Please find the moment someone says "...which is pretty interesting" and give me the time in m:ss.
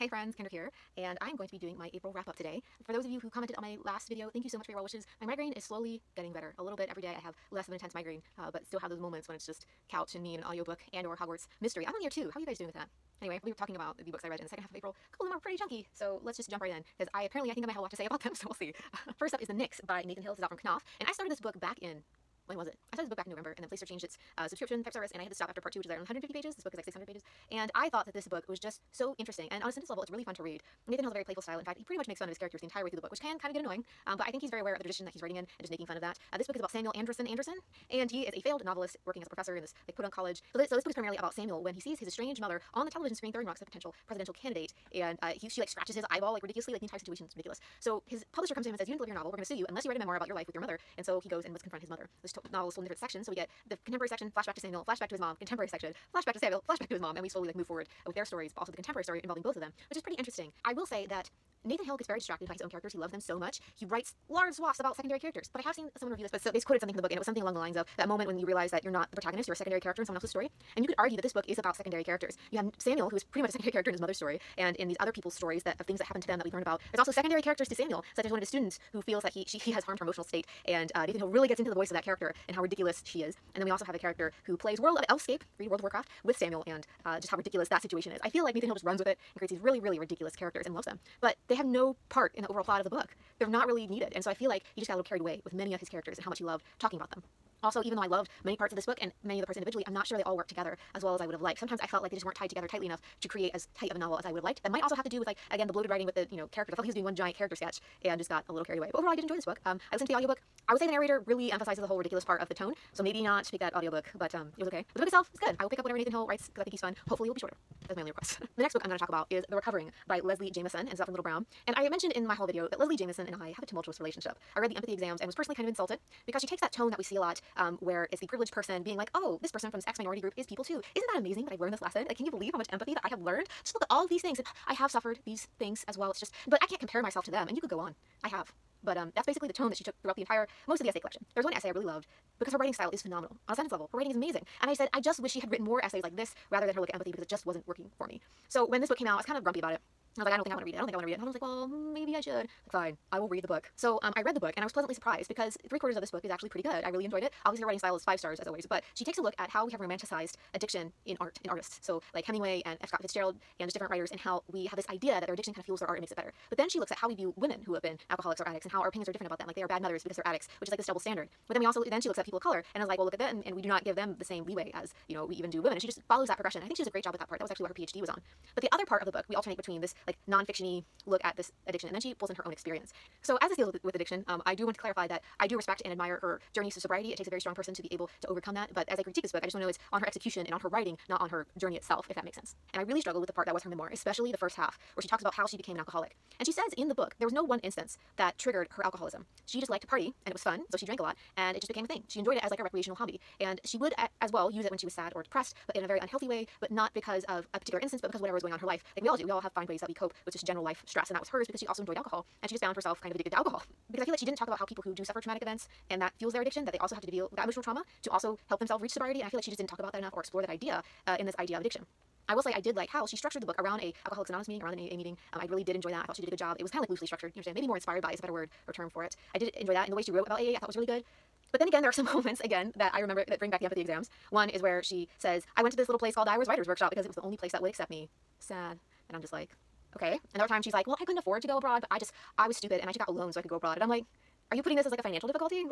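0:59.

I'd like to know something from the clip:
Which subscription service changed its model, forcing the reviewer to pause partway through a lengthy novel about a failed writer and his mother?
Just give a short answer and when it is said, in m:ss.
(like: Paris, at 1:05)
Playster, at 0:23.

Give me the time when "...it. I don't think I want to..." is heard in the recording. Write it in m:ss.
2:30.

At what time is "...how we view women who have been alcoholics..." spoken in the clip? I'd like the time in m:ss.
2:46.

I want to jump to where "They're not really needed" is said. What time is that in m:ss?
1:33.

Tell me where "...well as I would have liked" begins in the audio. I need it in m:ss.
1:41.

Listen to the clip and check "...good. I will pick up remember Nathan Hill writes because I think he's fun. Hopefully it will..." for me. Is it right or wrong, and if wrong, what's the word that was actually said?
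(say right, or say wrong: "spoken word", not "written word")
wrong: "whatever", not "remember".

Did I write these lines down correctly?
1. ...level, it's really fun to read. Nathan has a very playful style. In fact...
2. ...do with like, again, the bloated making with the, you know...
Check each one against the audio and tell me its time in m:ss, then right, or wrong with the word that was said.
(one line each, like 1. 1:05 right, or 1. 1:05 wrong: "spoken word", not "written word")
1. 0:29 right
2. 1:45 wrong: "writing", not "making".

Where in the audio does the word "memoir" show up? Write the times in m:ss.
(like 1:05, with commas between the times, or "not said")
0:49, 3:13.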